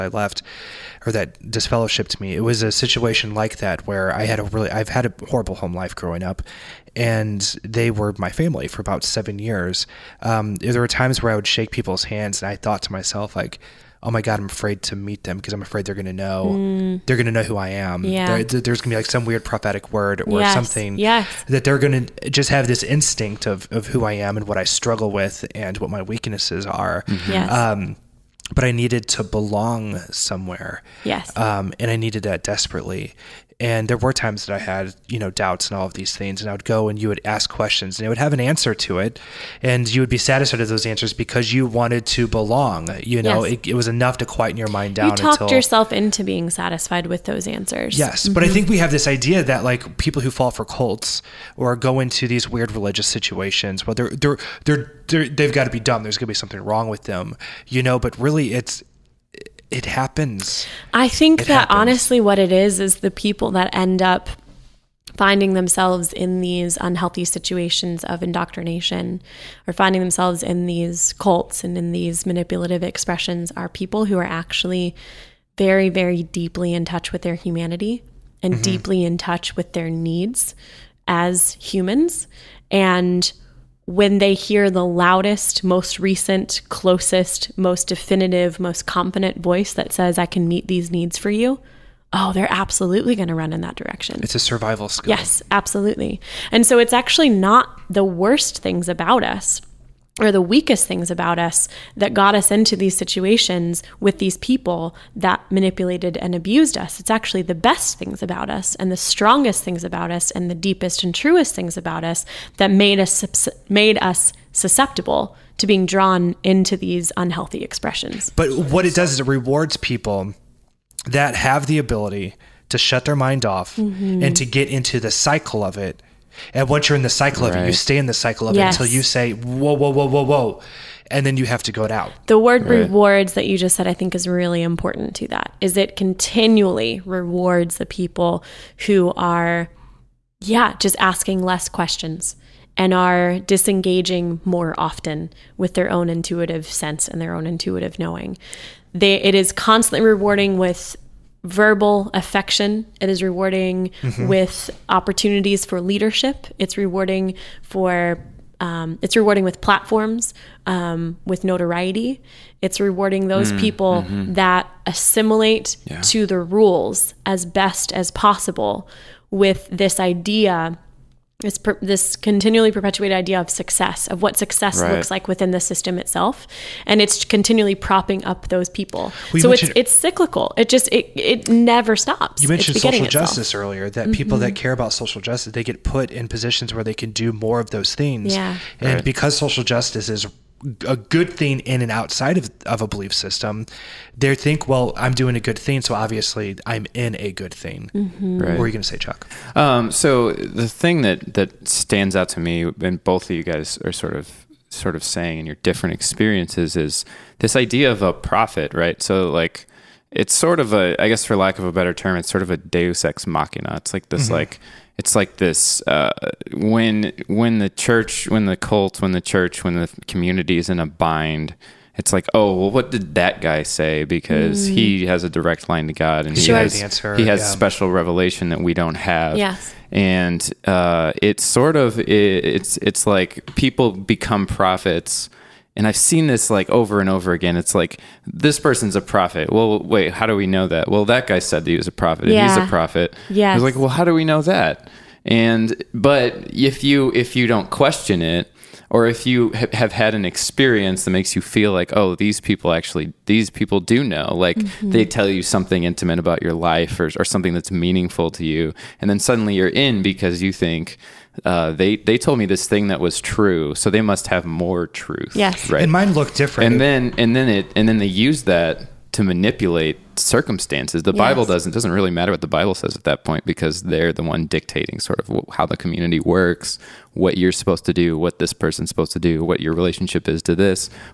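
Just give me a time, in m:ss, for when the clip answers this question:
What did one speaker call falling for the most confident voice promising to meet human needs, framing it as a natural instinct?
1:34.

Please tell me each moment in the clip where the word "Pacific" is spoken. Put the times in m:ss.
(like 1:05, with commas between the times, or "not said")
not said.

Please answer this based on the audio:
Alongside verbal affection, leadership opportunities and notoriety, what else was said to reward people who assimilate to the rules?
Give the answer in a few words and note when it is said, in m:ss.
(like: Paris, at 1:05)
Platforms, at 2:39.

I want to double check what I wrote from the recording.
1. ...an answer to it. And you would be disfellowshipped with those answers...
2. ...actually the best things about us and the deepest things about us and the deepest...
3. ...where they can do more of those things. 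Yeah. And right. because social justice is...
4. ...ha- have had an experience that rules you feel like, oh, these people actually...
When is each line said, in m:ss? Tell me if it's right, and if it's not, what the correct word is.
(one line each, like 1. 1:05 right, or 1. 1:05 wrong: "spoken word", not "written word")
1. 0:38 wrong: "satisfied", not "disfellowshipped"
2. 1:47 wrong: "strongest", not "deepest"
3. 3:06 right
4. 4:09 wrong: "makes", not "rules".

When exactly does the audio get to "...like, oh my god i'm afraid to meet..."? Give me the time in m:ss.
0:13.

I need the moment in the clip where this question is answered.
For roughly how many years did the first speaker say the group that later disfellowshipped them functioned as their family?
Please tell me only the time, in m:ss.
0:09.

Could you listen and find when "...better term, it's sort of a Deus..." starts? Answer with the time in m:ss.
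3:31.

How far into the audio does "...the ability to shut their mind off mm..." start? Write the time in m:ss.
2:01.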